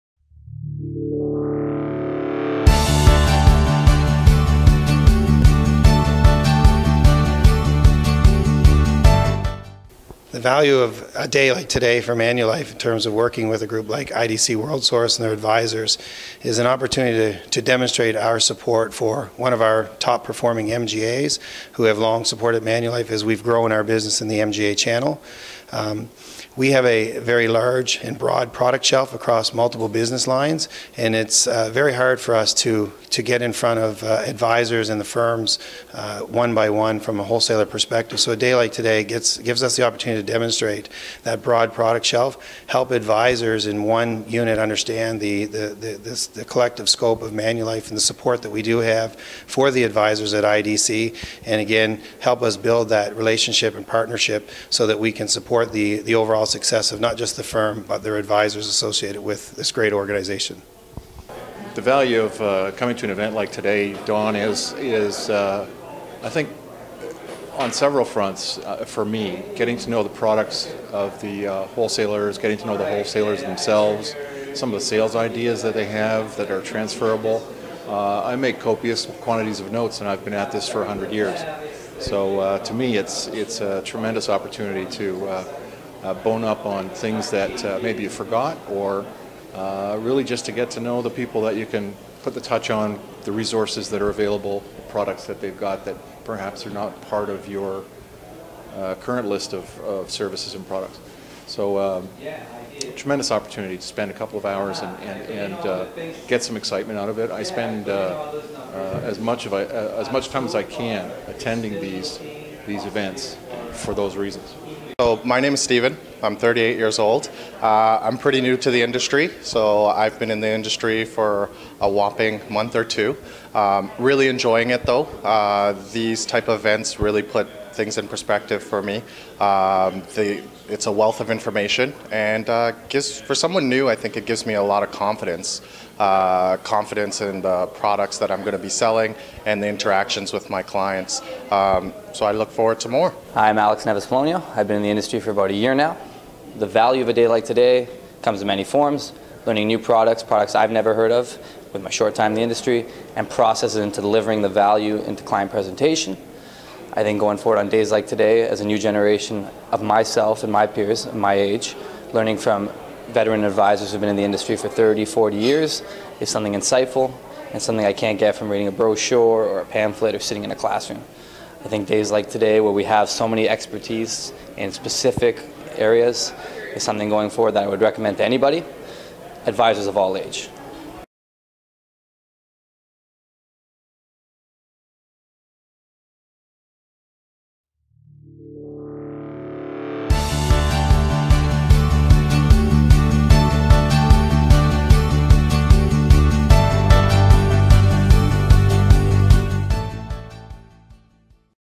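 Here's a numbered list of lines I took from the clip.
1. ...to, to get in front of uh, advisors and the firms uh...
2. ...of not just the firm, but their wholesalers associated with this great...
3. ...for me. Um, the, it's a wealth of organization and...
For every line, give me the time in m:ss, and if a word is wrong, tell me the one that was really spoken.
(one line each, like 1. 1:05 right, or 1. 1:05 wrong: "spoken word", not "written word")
1. 0:32 right
2. 0:56 wrong: "advisors", not "wholesalers"
3. 2:08 wrong: "information", not "organization".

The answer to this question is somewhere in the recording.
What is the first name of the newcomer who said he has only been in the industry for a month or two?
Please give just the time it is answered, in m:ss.
1:55.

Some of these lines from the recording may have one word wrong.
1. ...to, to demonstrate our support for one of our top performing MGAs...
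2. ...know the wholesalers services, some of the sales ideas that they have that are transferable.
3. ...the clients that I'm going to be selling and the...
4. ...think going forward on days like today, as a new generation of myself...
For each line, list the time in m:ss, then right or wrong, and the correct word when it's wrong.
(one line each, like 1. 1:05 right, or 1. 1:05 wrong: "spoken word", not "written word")
1. 0:17 right
2. 1:12 wrong: "themselves", not "services"
3. 2:17 wrong: "products", not "clients"
4. 2:37 right.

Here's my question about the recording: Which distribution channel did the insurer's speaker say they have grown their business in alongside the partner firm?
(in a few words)
MGA channel.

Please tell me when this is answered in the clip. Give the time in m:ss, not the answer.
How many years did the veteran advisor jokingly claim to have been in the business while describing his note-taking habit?
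1:20.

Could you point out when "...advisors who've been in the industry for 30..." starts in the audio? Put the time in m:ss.
2:43.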